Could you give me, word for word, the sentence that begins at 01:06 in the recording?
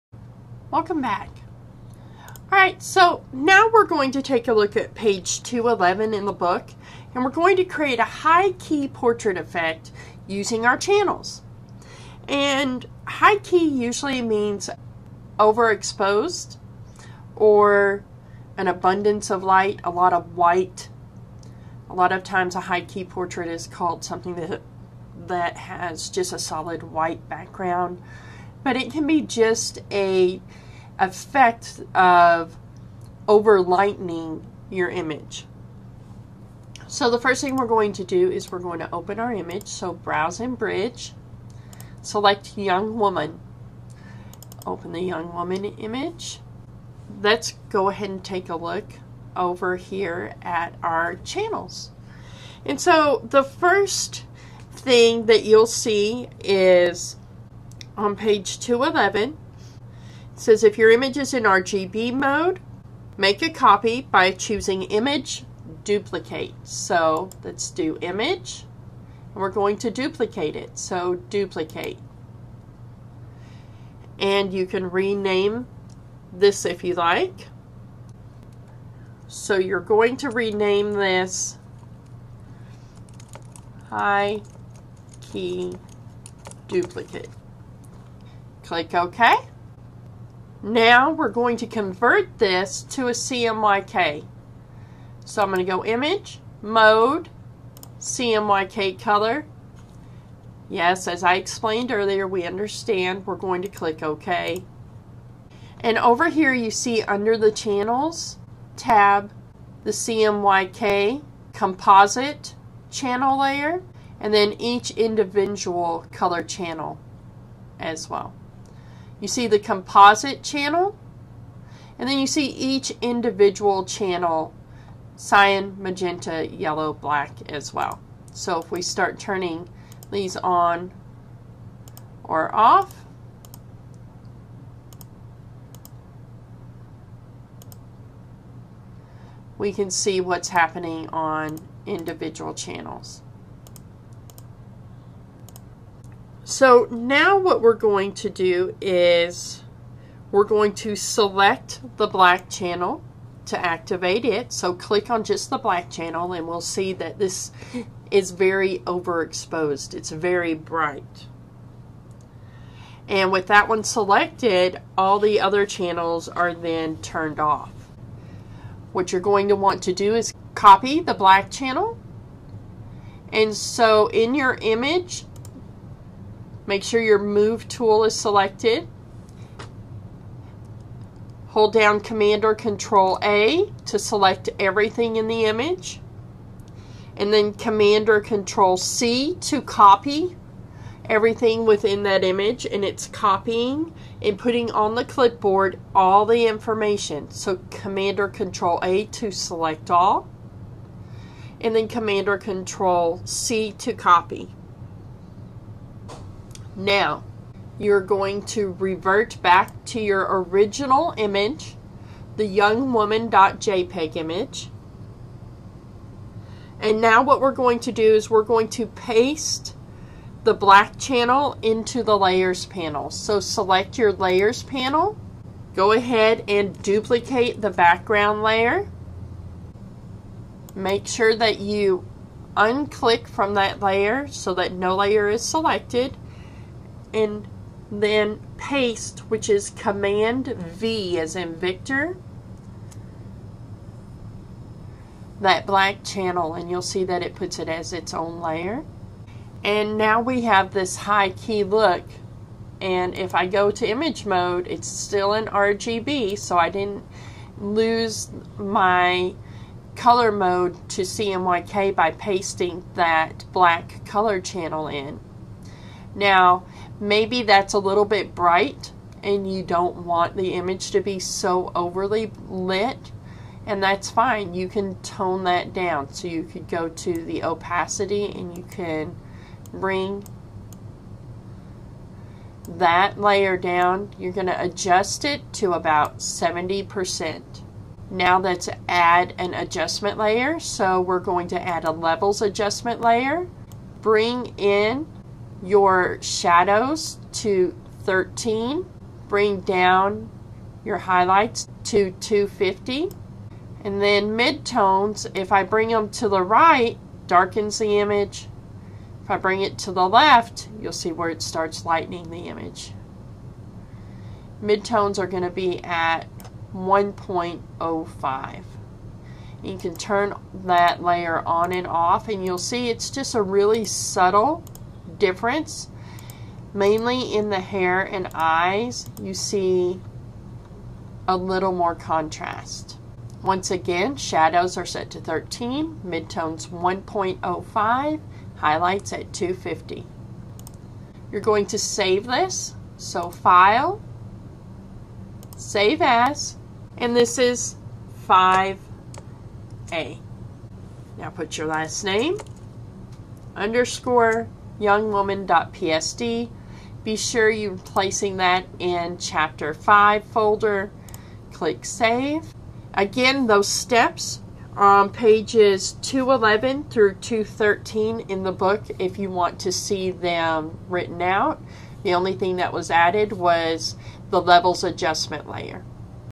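So let's do image and we're going to duplicate it.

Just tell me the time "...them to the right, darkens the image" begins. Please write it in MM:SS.
05:05.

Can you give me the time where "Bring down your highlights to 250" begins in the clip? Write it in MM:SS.
04:59.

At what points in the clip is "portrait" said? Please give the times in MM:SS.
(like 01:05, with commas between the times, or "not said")
00:08, 00:23.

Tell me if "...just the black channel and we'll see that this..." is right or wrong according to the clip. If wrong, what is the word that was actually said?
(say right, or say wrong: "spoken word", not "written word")
right.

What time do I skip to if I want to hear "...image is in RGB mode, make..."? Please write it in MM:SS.
01:00.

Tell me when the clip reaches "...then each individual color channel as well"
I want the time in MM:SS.
01:54.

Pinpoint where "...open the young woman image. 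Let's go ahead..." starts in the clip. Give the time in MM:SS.
00:44.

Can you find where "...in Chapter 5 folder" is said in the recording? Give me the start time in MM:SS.
05:58.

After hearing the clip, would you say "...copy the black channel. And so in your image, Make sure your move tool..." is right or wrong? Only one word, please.
right.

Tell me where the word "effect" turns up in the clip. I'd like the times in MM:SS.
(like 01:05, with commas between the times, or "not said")
00:09, 00:30.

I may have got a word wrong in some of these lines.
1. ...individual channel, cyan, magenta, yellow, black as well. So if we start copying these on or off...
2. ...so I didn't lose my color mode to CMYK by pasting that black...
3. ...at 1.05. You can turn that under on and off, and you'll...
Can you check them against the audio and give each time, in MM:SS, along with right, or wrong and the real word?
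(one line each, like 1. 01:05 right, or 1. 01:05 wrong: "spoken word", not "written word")
1. 02:03 wrong: "turning", not "copying"
2. 04:16 right
3. 05:15 wrong: "layer", not "under".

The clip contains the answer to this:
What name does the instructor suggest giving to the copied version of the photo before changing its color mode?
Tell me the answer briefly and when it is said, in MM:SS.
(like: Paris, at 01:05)
high key duplicate, at 01:23.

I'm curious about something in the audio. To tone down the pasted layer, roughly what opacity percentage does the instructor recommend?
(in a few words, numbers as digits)
70%.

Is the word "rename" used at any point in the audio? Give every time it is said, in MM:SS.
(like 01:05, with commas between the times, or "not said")
01:14, 01:20.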